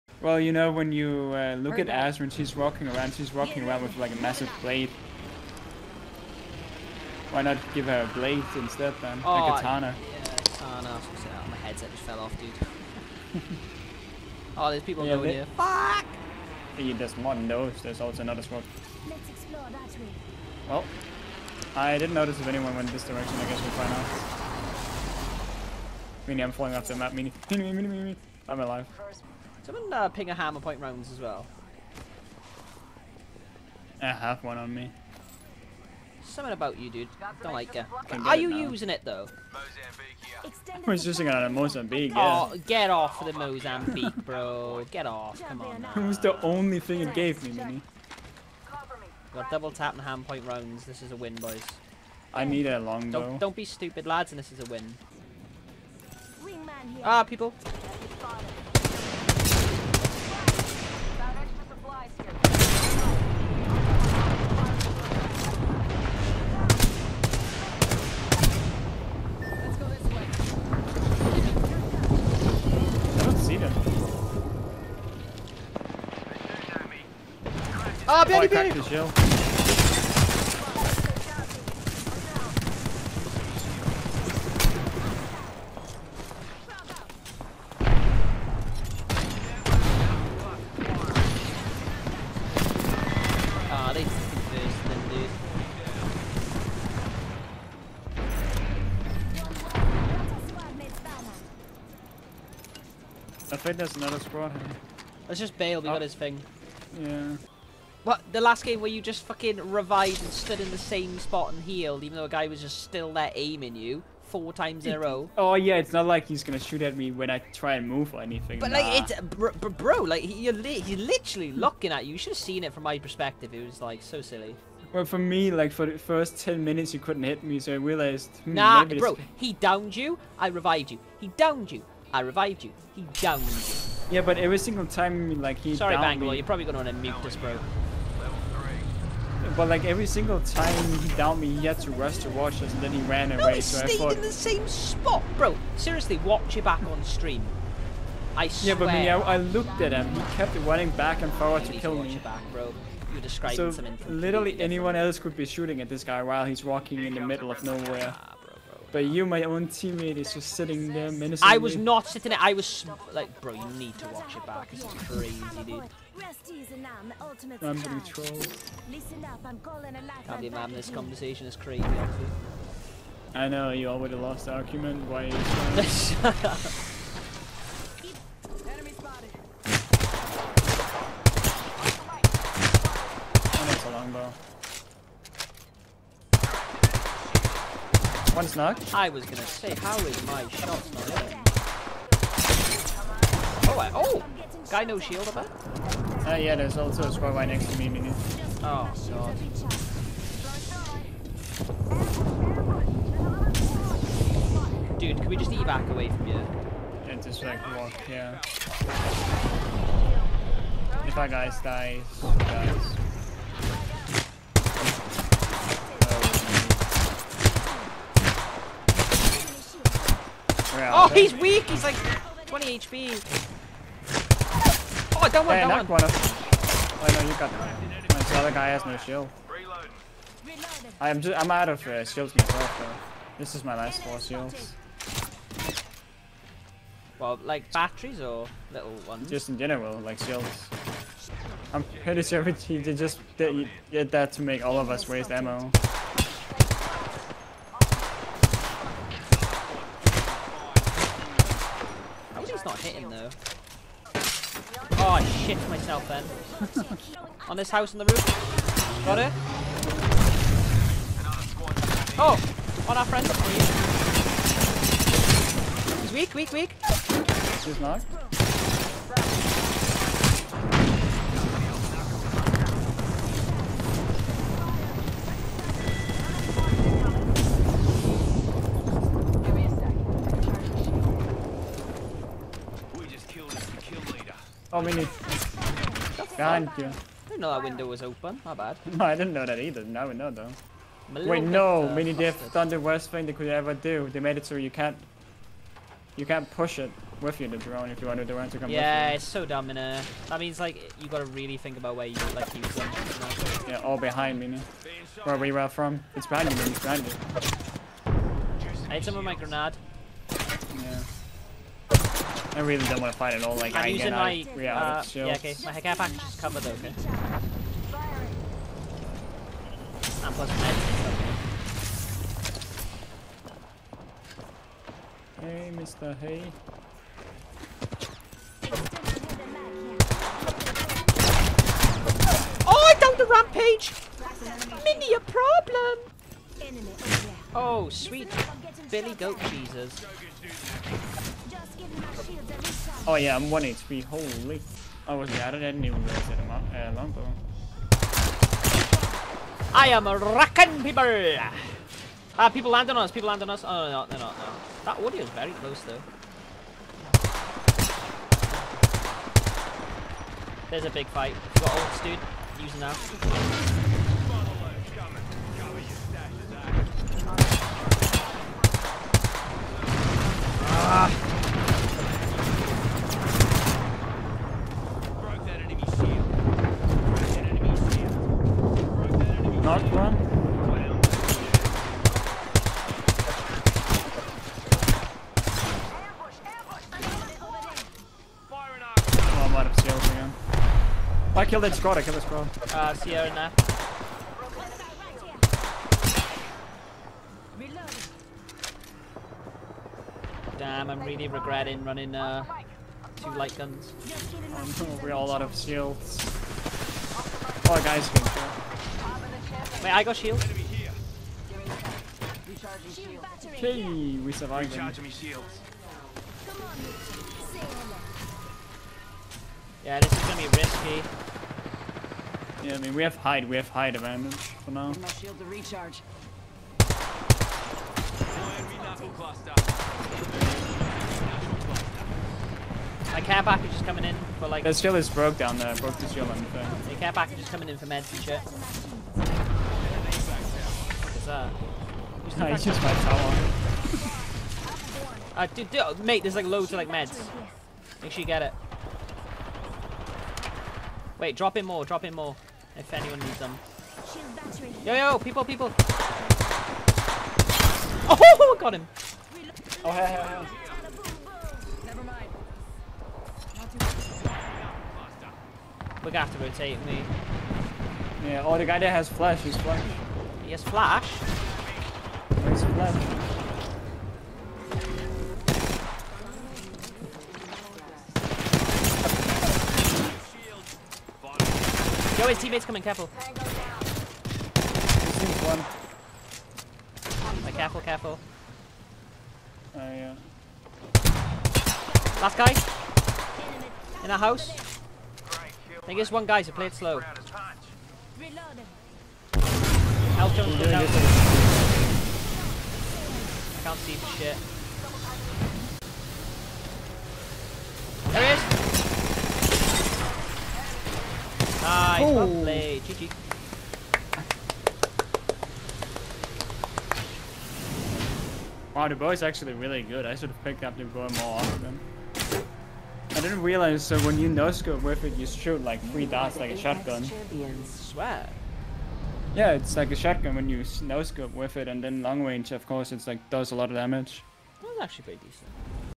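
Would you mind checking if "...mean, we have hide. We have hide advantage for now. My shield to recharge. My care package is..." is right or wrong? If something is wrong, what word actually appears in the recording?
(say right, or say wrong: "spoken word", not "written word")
right.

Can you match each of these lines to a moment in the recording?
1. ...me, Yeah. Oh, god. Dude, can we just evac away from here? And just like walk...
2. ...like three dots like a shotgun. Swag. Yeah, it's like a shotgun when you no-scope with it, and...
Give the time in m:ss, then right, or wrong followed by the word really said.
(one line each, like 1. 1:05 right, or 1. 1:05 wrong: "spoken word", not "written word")
1. 3:17 wrong: "Minu", not "Yeah"
2. 8:45 right.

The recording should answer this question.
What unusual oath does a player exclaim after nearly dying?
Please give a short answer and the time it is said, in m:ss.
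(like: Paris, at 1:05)
Sweet Billy Goat Jesus, at 5:37.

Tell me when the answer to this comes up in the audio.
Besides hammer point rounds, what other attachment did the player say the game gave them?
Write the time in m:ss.
0:49.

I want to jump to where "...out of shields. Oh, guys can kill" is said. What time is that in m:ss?
6:45.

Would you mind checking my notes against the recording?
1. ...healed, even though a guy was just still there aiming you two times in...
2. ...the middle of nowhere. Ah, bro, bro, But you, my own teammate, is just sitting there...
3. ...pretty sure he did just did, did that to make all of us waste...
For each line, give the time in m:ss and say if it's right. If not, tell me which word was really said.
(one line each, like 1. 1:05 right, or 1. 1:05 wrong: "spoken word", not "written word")
1. 1:51 wrong: "four", not "two"
2. 2:37 right
3. 4:02 right.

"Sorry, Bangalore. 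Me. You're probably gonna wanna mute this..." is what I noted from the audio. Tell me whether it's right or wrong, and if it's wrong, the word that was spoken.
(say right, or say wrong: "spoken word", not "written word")
right.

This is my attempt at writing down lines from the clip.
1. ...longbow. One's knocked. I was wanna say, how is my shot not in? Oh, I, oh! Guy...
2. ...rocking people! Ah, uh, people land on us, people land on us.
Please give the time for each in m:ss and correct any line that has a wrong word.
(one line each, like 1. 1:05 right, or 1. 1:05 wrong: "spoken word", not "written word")
1. 3:03 wrong: "gonna", not "wanna"
2. 5:50 right.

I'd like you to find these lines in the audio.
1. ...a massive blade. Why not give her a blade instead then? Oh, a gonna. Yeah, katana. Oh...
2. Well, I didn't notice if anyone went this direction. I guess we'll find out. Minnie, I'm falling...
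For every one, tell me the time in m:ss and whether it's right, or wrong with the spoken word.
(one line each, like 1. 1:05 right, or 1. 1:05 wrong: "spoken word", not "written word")
1. 0:04 wrong: "katana", not "gonna"
2. 0:20 right.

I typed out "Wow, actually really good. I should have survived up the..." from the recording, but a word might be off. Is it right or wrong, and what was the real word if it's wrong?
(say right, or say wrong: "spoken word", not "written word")
wrong: "picked", not "survived".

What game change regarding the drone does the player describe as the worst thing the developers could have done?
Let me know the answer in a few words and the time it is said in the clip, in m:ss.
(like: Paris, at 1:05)
can't push it, at 4:56.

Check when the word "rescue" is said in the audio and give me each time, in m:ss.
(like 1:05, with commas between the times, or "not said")
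not said.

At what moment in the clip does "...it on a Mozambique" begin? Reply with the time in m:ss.
0:41.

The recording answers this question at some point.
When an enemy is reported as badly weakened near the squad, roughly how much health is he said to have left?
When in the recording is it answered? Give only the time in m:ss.
3:41.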